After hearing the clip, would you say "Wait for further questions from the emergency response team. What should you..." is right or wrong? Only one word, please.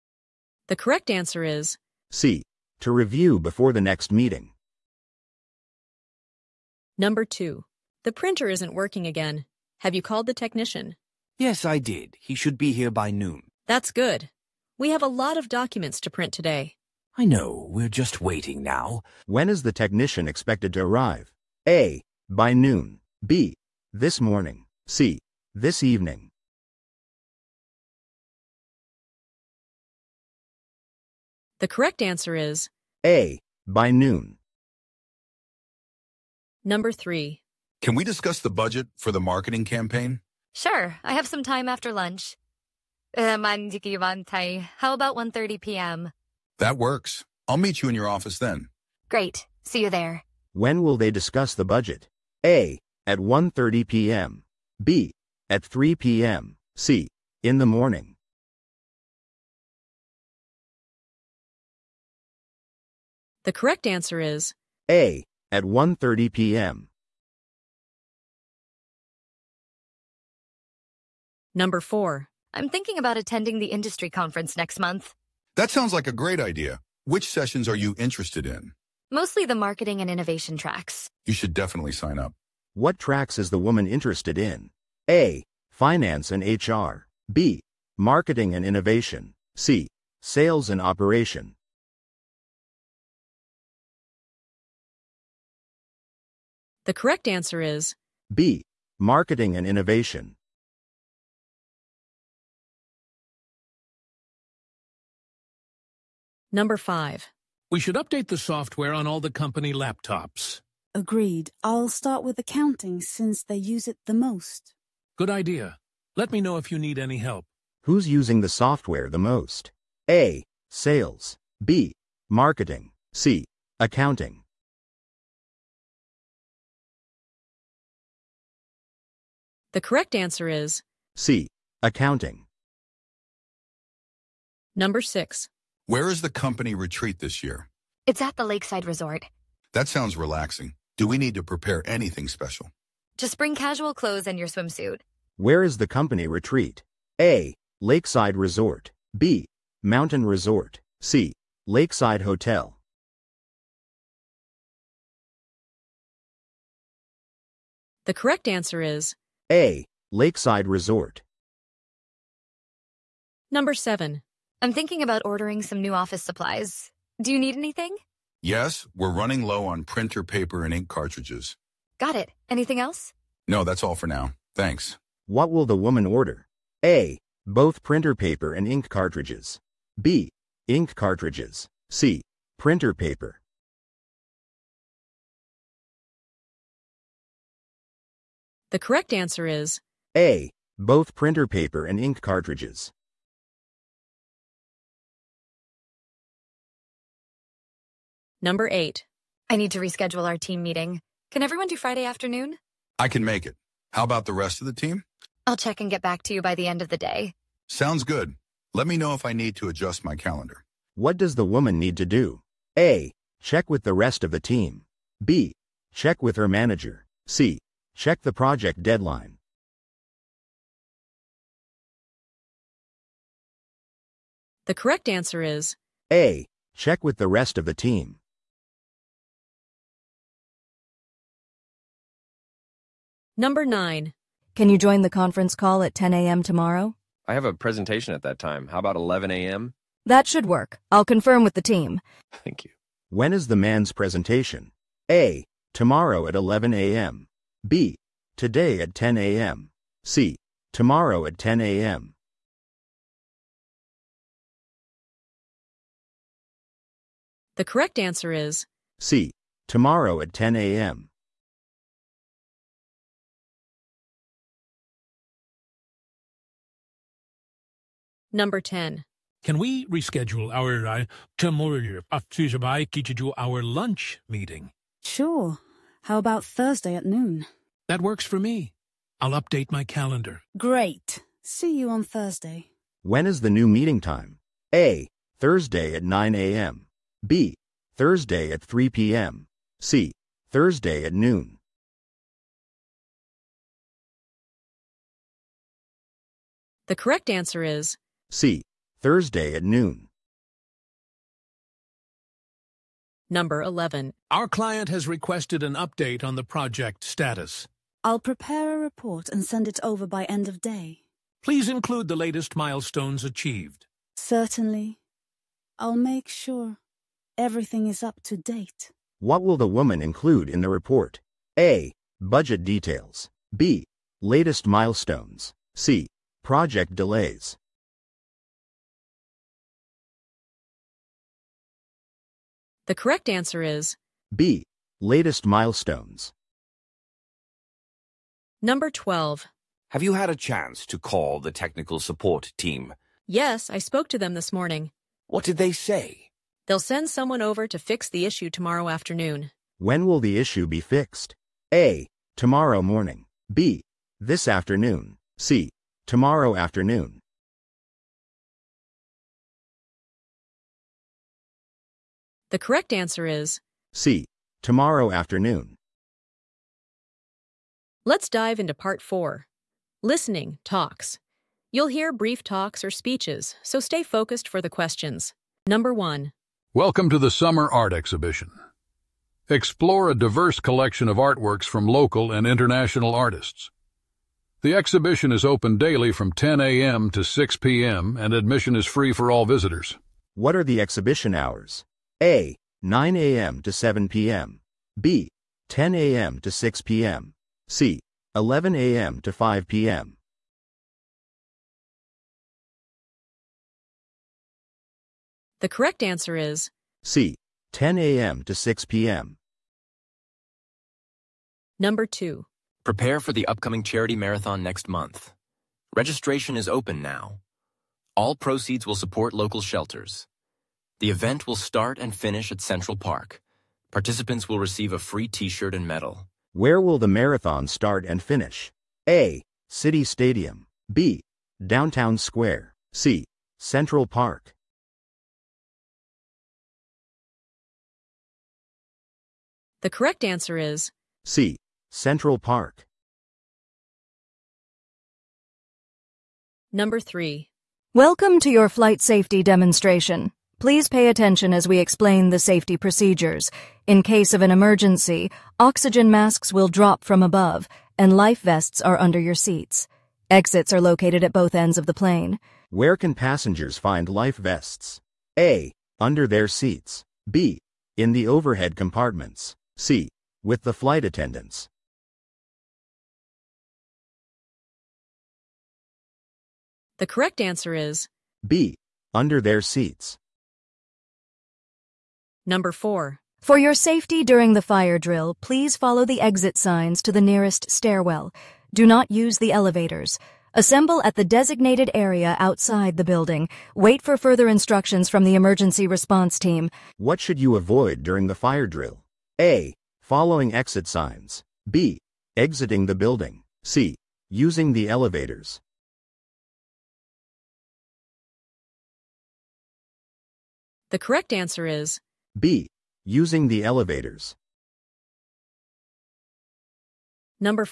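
wrong.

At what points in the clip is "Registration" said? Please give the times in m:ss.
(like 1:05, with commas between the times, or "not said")
6:55.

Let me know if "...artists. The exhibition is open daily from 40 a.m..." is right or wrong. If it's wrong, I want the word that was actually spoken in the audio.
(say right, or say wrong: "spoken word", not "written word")
wrong: "10", not "40".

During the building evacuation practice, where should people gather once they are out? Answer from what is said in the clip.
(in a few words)
Designated area outside.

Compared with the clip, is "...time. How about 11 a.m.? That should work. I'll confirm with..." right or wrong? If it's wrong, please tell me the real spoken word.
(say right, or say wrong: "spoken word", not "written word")
right.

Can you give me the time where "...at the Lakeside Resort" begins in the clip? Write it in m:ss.
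2:18.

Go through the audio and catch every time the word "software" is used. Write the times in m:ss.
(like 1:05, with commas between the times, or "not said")
1:48, 1:58.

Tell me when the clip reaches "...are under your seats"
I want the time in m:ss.
7:38.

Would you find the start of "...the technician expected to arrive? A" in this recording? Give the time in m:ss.
0:19.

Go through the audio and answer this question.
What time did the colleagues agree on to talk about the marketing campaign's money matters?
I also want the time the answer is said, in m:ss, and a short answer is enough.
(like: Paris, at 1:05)
1:30 p.m., at 0:43.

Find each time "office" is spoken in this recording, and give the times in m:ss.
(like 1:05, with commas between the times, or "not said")
0:48, 2:45.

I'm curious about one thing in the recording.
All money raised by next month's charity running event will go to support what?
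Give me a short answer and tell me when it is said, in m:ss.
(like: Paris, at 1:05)
Local shelters, at 6:58.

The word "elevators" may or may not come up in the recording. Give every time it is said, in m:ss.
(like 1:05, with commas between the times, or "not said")
8:09, 8:24, 8:33.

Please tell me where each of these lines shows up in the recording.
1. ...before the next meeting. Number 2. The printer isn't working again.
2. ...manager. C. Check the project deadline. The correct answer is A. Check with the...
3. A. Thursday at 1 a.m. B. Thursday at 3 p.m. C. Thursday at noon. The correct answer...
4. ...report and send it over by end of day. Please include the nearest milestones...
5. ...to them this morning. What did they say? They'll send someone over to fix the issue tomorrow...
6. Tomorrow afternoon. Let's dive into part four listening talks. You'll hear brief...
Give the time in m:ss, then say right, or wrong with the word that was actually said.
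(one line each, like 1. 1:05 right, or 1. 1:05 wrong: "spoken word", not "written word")
1. 0:03 right
2. 3:36 right
3. 4:44 wrong: "9", not "1"
4. 5:08 wrong: "latest", not "nearest"
5. 5:44 right
6. 6:04 right.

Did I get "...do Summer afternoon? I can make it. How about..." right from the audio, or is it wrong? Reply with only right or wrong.
wrong.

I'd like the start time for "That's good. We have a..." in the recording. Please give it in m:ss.
0:13.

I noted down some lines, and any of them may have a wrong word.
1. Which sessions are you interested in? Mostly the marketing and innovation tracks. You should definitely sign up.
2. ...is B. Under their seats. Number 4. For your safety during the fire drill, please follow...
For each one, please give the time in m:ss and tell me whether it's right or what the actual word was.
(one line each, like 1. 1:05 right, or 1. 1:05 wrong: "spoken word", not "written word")
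1. 1:17 right
2. 7:57 right.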